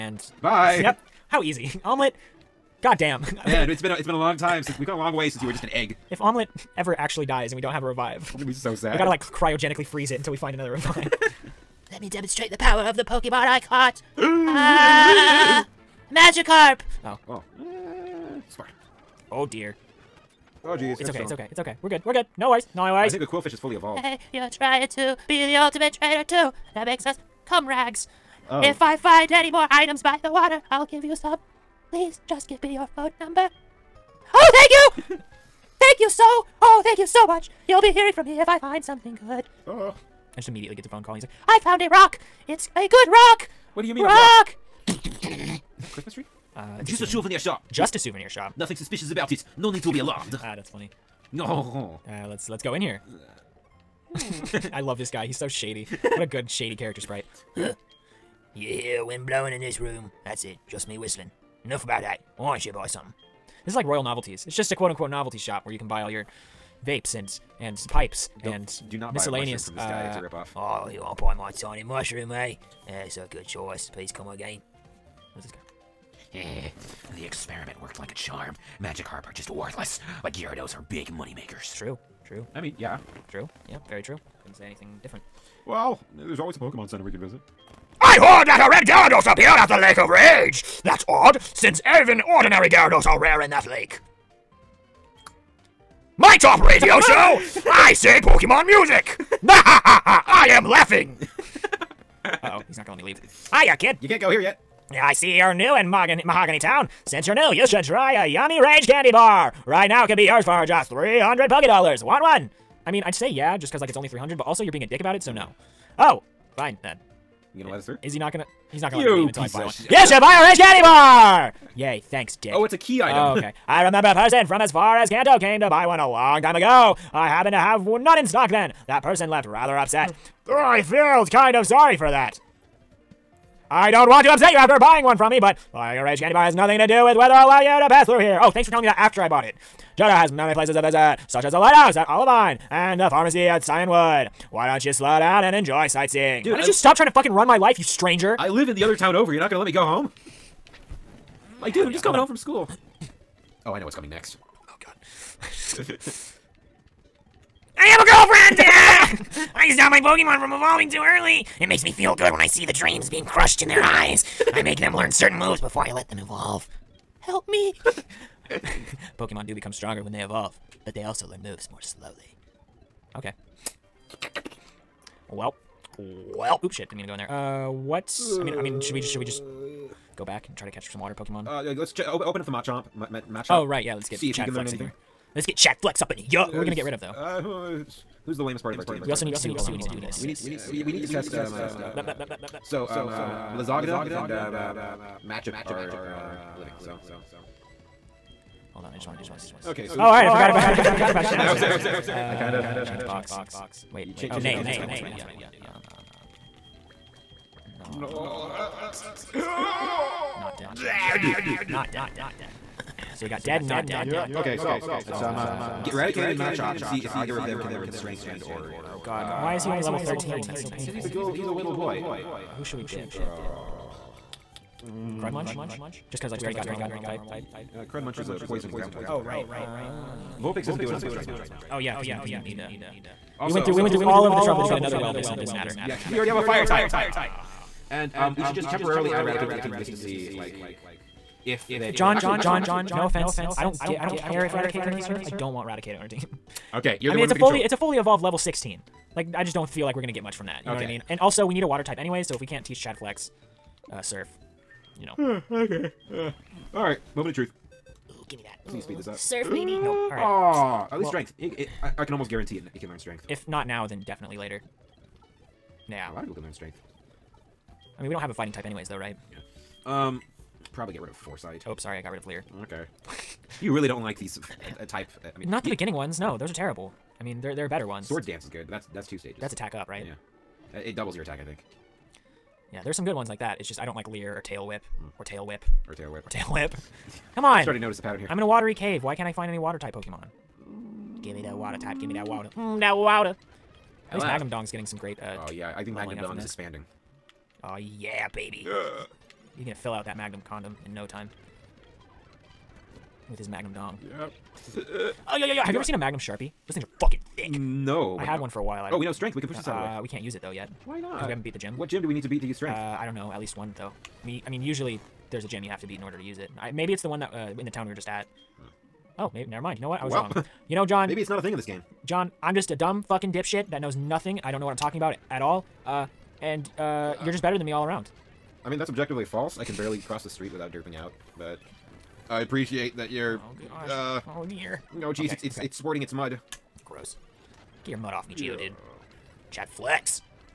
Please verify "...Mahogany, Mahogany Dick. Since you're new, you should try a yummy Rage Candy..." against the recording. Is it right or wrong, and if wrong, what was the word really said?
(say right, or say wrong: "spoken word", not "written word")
wrong: "Town", not "Dick".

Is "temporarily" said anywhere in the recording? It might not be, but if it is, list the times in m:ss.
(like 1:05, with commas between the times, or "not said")
3:58.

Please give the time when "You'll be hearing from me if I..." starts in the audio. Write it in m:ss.
0:37.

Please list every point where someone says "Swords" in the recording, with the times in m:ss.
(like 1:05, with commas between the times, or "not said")
4:38.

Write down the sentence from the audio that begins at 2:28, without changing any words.
I live in the other town over.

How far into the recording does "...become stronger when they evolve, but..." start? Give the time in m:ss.
2:49.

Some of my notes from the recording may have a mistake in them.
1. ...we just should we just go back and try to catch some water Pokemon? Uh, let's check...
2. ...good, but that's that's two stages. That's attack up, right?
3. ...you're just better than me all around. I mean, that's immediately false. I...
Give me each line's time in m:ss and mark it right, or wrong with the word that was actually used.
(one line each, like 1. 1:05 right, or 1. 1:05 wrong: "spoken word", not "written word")
1. 2:58 right
2. 4:38 right
3. 5:27 wrong: "objectively", not "immediately".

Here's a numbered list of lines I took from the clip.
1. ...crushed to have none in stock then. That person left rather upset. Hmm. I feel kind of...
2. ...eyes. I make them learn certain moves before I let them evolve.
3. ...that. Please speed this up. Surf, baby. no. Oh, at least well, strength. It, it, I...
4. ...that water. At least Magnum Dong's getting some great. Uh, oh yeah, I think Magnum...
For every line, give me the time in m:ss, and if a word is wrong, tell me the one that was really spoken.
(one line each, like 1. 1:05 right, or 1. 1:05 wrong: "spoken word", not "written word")
1. 2:07 wrong: "happened", not "crushed"
2. 2:43 right
3. 4:18 right
4. 4:52 right.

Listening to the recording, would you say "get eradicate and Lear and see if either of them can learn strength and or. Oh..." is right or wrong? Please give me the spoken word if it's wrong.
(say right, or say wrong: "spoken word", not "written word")
wrong: "Machop", not "Lear".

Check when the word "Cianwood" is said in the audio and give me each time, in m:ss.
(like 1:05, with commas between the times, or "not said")
2:23.